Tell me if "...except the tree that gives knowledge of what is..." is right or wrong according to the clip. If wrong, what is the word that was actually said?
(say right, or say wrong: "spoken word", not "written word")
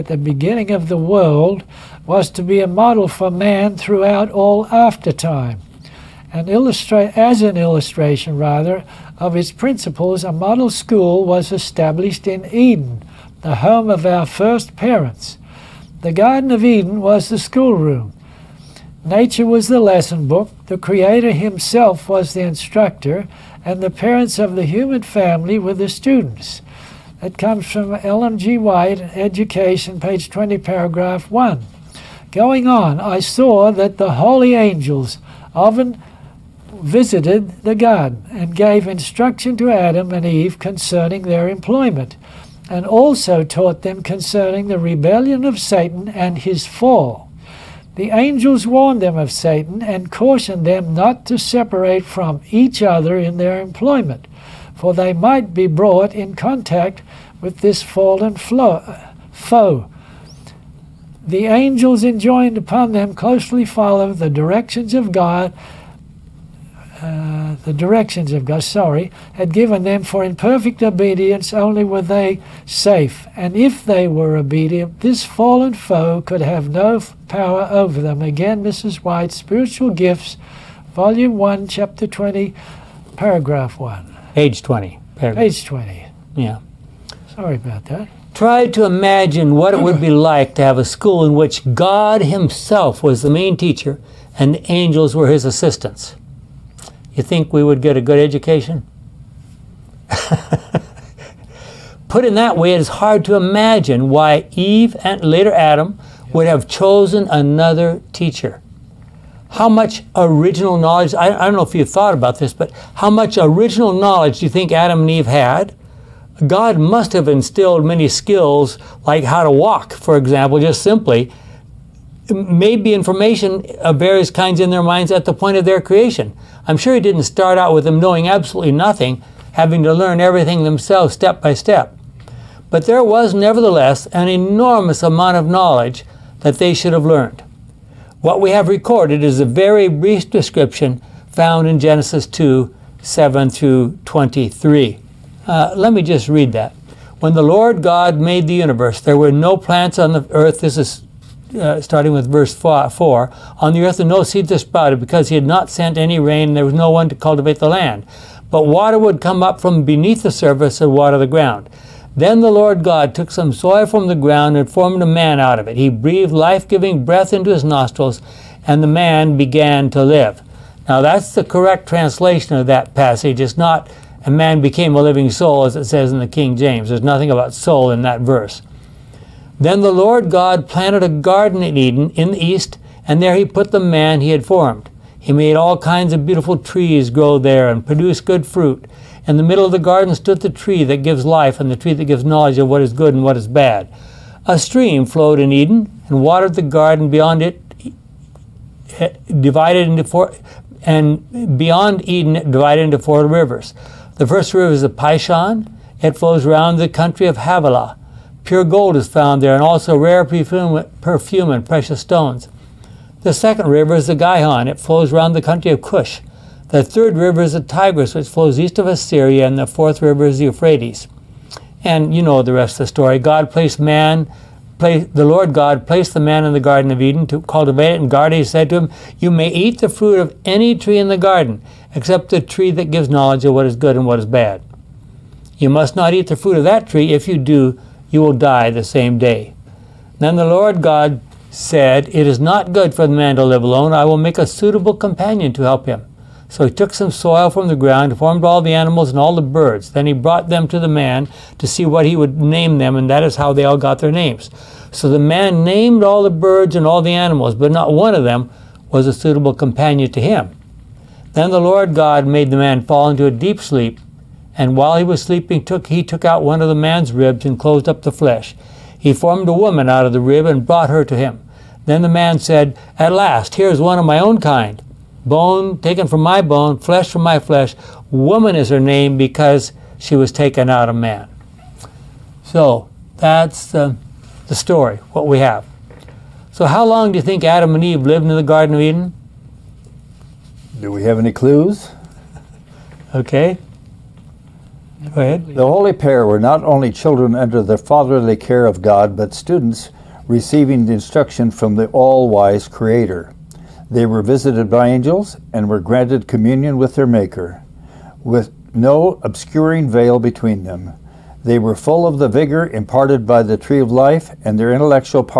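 right.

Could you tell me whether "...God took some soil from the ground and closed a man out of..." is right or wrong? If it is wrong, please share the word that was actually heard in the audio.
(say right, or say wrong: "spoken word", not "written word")
wrong: "formed", not "closed".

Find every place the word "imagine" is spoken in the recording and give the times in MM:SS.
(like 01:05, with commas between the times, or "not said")
01:28, 01:43.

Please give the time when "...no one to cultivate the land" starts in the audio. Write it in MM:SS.
02:36.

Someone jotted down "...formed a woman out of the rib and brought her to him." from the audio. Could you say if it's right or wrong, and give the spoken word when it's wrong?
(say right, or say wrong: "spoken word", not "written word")
right.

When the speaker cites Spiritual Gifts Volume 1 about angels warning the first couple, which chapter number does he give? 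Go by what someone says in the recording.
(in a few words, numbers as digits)
Chapter 20.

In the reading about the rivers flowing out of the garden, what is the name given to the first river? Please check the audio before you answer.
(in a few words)
Pishon.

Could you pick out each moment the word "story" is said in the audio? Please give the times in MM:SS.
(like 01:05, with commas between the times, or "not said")
03:42, 04:44.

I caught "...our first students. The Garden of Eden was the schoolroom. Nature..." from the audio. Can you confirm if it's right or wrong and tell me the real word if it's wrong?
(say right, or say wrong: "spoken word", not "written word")
wrong: "parents", not "students".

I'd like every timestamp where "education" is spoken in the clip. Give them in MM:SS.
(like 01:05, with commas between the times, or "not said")
00:29, 01:38.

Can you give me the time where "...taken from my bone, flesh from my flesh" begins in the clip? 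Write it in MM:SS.
04:35.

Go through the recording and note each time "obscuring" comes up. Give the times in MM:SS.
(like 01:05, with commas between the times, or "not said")
05:09.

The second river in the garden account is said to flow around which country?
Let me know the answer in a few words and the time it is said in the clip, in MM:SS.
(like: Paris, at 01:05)
Cush, at 03:35.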